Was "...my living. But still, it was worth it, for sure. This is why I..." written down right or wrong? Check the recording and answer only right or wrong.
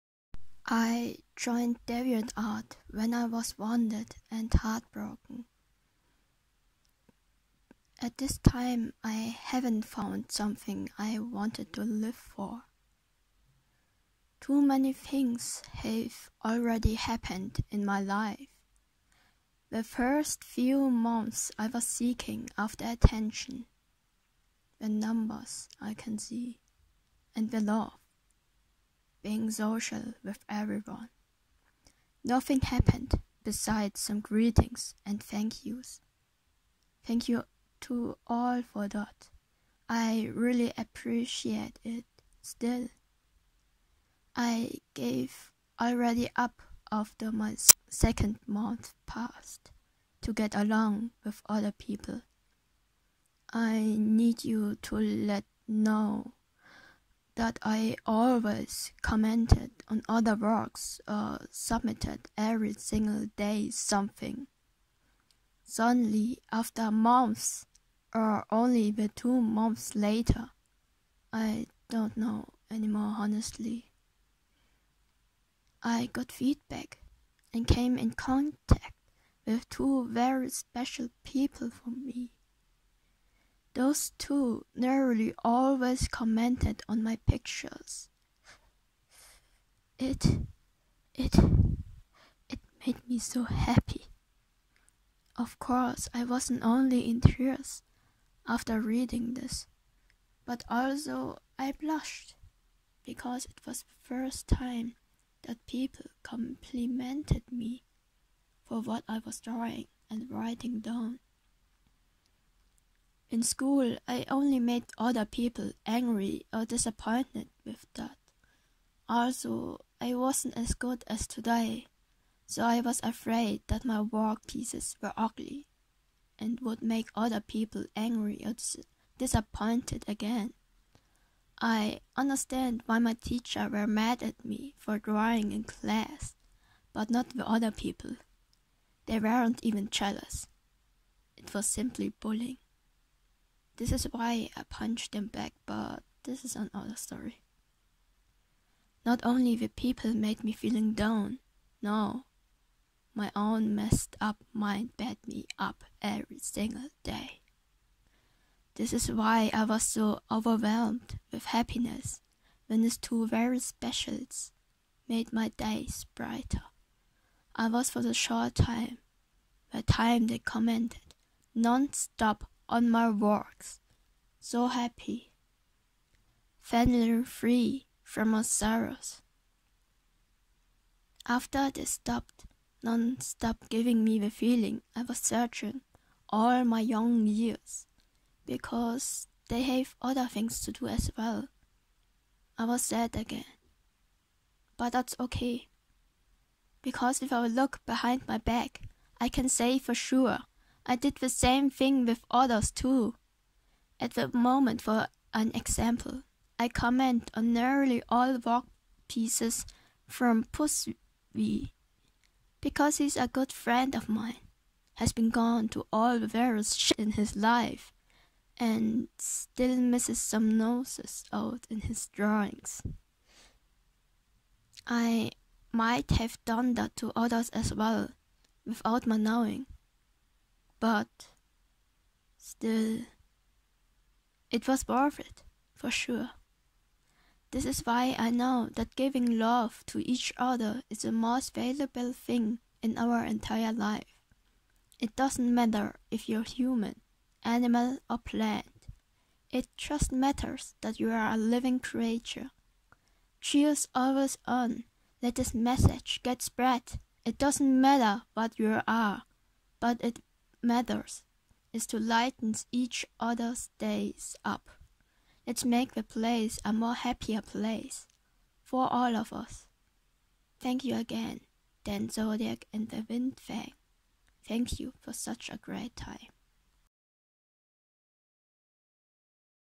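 wrong.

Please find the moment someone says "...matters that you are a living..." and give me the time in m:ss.
4:10.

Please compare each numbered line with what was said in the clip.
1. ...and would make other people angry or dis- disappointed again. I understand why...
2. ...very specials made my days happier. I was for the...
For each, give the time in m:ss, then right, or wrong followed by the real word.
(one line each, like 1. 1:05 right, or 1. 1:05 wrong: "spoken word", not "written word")
1. 2:06 right
2. 2:43 wrong: "brighter", not "happier".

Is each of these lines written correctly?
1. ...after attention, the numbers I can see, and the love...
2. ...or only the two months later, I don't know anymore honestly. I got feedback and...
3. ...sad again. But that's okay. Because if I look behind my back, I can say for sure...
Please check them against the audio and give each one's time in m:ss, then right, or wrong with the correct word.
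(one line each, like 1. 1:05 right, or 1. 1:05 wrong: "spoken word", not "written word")
1. 0:22 right
2. 1:08 right
3. 3:12 right.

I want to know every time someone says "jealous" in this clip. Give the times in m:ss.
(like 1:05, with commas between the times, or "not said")
2:19.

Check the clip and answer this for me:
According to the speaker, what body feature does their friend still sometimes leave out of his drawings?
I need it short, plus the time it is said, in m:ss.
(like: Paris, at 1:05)
noses, at 3:40.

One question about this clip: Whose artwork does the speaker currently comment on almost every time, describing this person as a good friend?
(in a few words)
Puswi.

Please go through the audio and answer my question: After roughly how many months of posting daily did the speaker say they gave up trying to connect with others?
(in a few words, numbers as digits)
2.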